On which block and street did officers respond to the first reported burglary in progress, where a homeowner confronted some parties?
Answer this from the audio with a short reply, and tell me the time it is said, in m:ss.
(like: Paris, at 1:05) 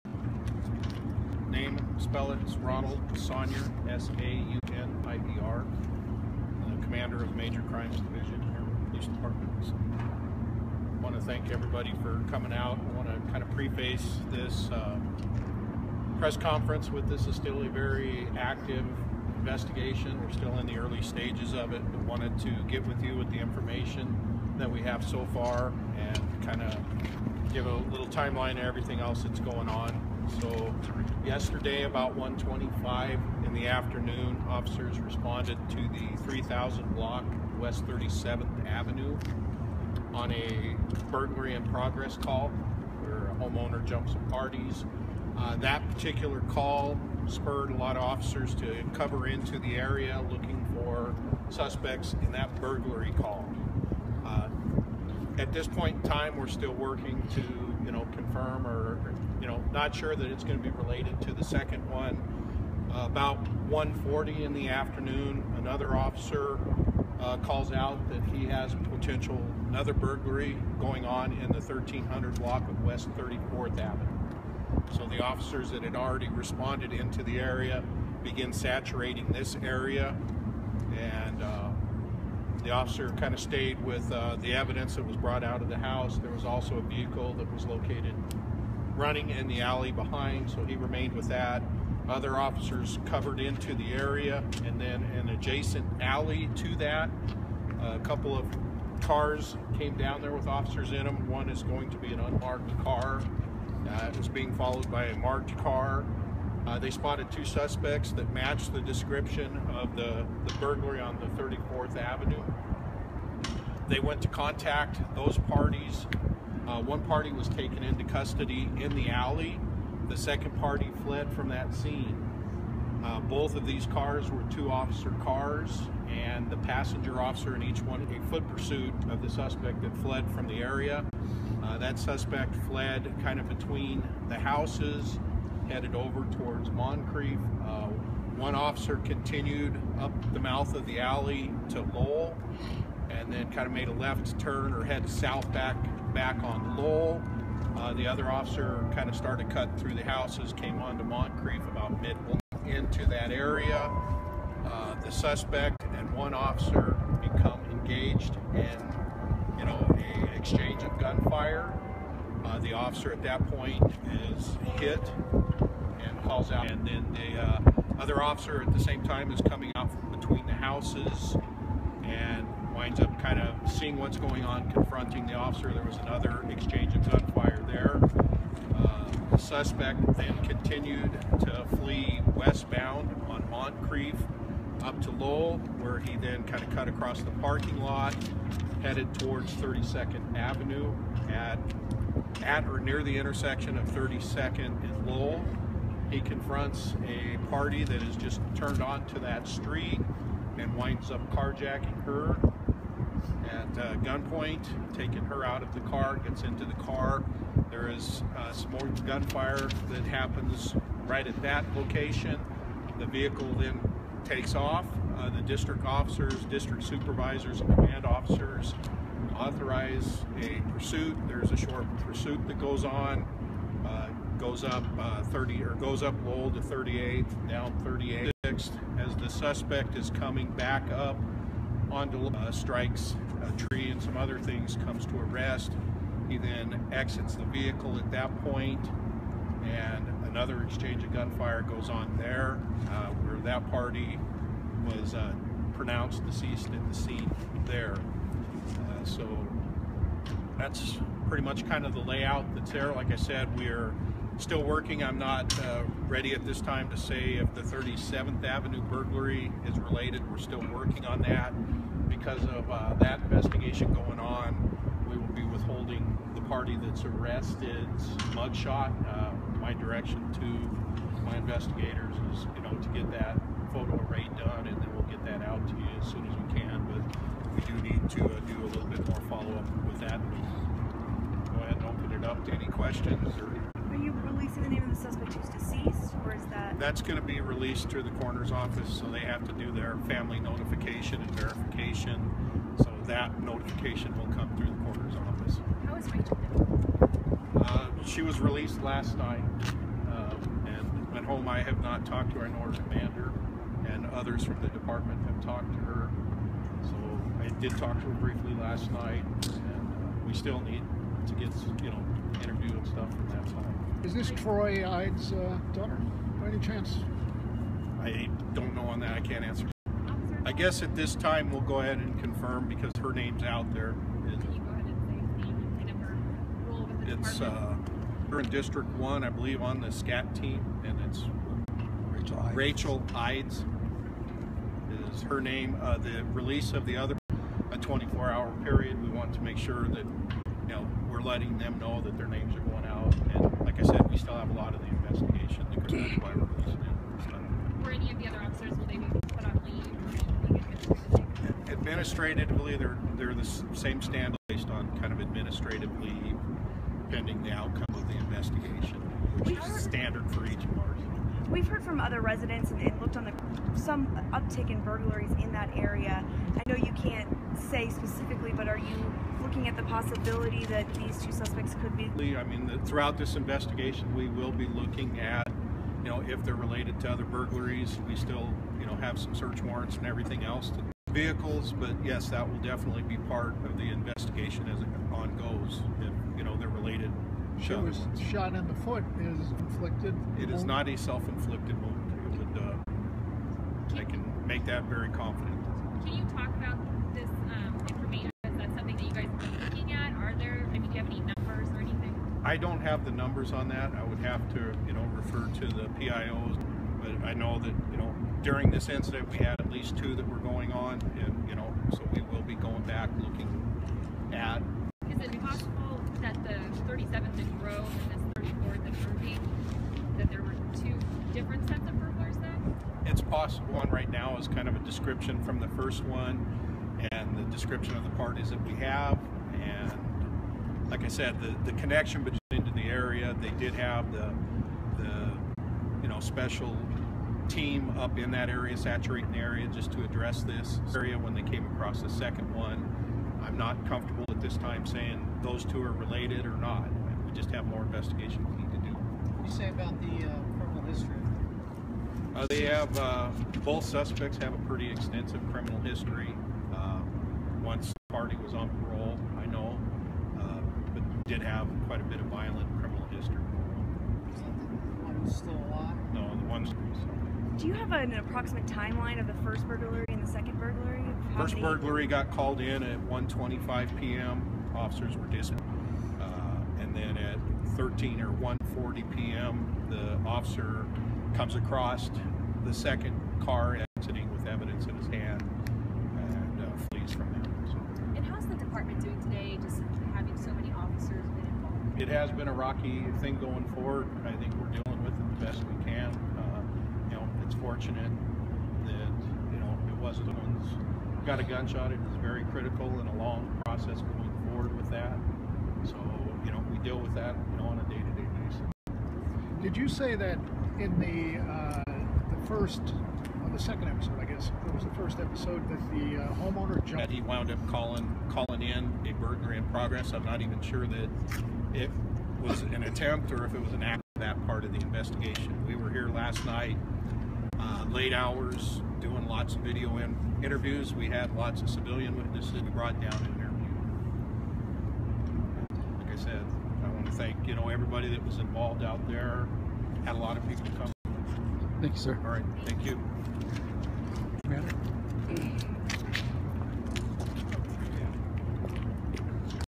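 3000 block West 37th Avenue, at 0:36.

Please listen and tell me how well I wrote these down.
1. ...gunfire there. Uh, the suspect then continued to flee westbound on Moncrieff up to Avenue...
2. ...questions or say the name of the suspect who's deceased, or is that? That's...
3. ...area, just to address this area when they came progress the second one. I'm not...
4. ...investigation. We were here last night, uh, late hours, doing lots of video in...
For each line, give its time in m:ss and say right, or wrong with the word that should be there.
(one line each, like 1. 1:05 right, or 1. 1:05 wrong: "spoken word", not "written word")
1. 2:57 wrong: "Lowell", not "Avenue"
2. 4:42 right
3. 7:19 wrong: "across", not "progress"
4. 8:44 right.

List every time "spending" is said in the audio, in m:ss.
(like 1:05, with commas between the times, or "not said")
not said.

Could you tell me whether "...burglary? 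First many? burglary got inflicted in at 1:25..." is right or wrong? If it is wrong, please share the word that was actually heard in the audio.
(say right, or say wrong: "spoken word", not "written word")
wrong: "called", not "inflicted".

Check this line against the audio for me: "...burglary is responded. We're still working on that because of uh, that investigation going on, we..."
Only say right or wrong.
wrong.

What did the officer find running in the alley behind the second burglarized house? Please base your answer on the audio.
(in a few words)
a vehicle.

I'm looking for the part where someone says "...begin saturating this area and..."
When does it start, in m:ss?
1:18.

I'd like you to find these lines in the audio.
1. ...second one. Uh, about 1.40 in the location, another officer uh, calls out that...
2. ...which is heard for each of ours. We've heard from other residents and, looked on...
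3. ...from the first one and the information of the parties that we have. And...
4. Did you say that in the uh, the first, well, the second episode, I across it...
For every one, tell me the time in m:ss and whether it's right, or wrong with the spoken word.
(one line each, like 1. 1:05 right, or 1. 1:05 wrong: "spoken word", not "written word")
1. 1:01 wrong: "afternoon", not "location"
2. 5:59 wrong: "standard", not "heard"
3. 7:05 wrong: "description", not "information"
4. 8:29 wrong: "guess", not "across".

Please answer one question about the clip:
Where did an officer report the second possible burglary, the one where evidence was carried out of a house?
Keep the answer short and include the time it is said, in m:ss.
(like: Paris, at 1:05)
1300 block of West 34th Avenue, at 1:11.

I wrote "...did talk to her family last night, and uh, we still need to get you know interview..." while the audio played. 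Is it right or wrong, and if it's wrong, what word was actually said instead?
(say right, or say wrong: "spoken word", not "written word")
wrong: "briefly", not "family".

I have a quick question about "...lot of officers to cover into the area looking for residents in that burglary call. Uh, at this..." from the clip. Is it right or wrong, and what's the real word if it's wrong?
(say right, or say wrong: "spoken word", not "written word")
wrong: "suspects", not "residents".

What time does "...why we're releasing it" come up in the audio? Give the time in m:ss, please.
5:46.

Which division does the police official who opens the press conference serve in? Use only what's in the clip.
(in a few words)
Major Crimes Division.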